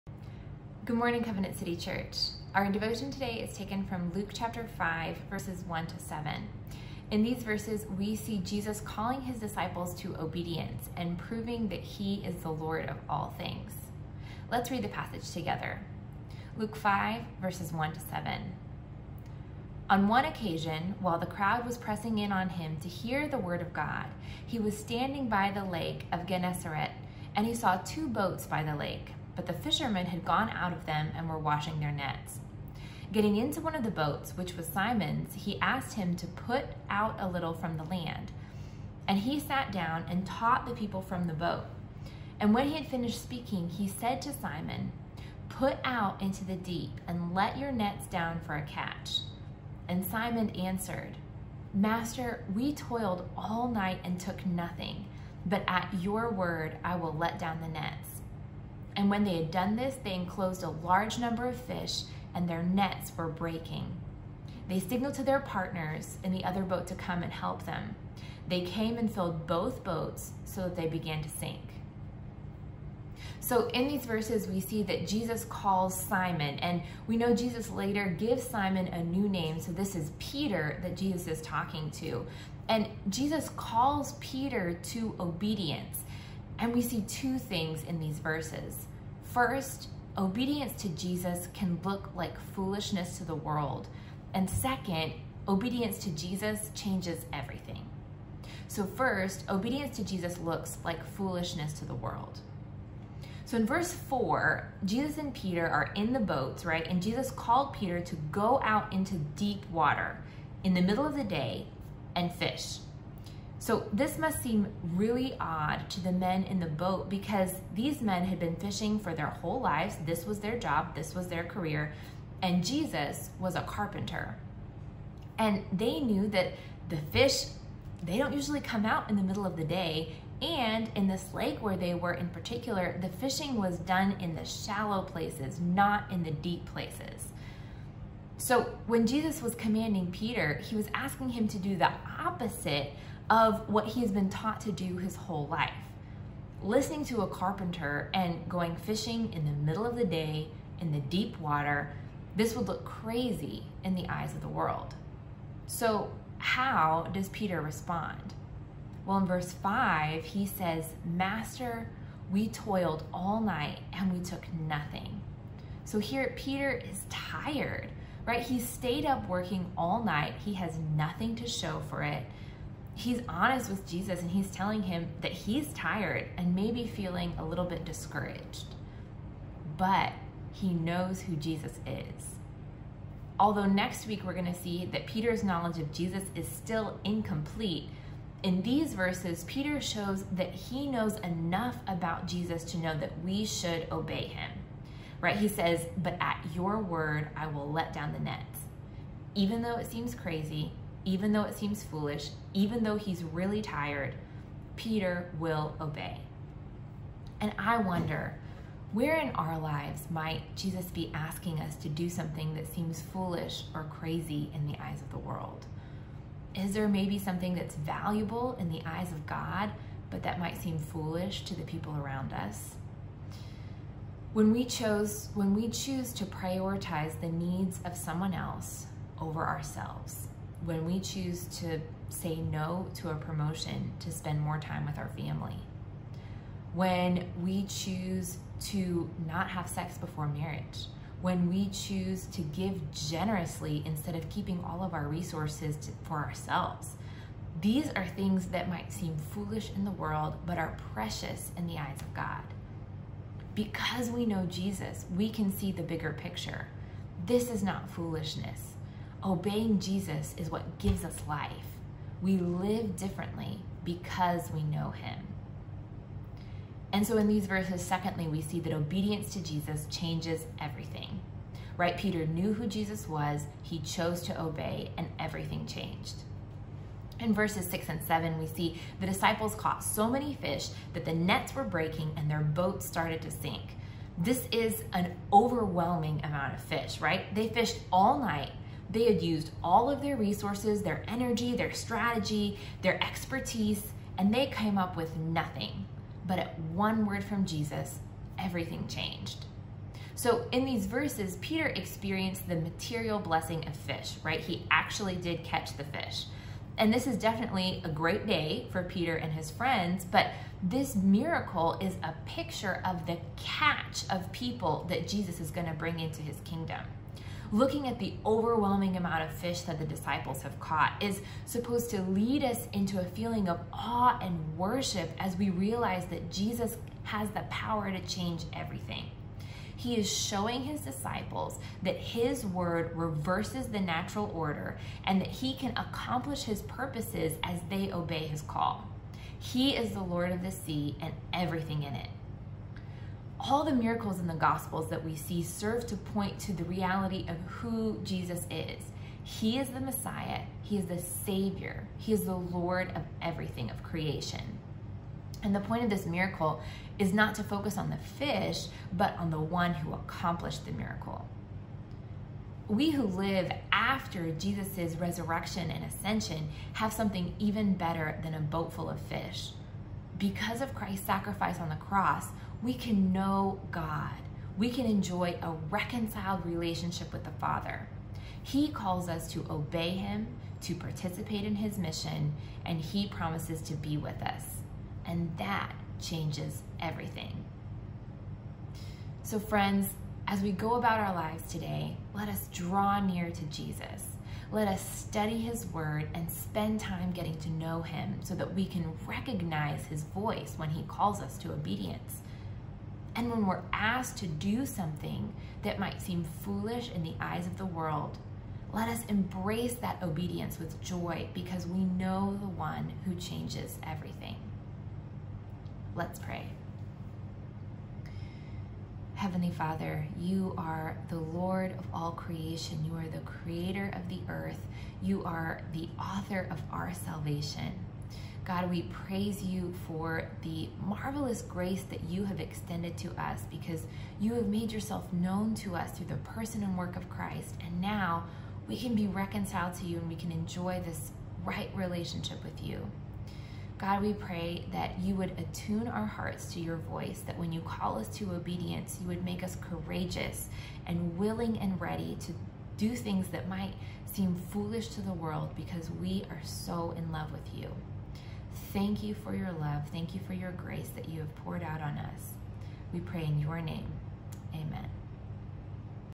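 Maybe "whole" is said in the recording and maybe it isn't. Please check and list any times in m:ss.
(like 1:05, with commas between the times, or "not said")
1:59, 2:25.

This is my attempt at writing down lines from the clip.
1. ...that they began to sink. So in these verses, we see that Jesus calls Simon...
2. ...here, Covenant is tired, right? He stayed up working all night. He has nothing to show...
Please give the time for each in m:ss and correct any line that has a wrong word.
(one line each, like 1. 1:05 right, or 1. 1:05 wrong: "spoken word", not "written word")
1. 1:10 right
2. 2:45 wrong: "Peter", not "Covenant".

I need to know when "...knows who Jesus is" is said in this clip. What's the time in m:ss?
3:00.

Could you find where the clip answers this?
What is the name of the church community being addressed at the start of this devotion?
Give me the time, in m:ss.
0:01.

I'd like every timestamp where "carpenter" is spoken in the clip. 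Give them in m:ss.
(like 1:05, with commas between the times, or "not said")
2:03, 2:27.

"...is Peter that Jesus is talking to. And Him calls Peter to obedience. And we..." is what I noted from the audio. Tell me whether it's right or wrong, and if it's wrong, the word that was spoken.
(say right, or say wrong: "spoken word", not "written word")
wrong: "Jesus", not "Him".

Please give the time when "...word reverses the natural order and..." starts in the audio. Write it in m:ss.
5:32.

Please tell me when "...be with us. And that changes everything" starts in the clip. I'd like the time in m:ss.
6:23.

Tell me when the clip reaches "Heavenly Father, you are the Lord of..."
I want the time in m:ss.
6:59.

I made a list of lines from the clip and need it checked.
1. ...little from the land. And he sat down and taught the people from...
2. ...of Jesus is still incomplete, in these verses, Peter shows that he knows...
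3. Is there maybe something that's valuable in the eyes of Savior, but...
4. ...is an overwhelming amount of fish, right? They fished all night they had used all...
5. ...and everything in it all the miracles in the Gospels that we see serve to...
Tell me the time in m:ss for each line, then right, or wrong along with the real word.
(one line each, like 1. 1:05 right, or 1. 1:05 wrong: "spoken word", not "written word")
1. 0:37 right
2. 3:05 right
3. 3:36 wrong: "God", not "Savior"
4. 4:44 right
5. 5:41 right.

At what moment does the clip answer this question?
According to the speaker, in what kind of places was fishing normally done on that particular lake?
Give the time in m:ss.
2:14.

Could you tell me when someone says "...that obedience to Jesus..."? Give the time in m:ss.
4:28.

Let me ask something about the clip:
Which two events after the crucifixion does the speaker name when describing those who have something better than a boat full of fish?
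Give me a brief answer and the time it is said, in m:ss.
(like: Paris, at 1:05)
resurrection and ascension, at 6:04.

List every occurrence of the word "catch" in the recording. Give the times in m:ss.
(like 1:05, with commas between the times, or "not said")
0:48, 5:05, 5:13.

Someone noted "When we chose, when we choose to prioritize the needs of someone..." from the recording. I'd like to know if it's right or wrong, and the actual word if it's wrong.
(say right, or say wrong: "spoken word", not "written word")
right.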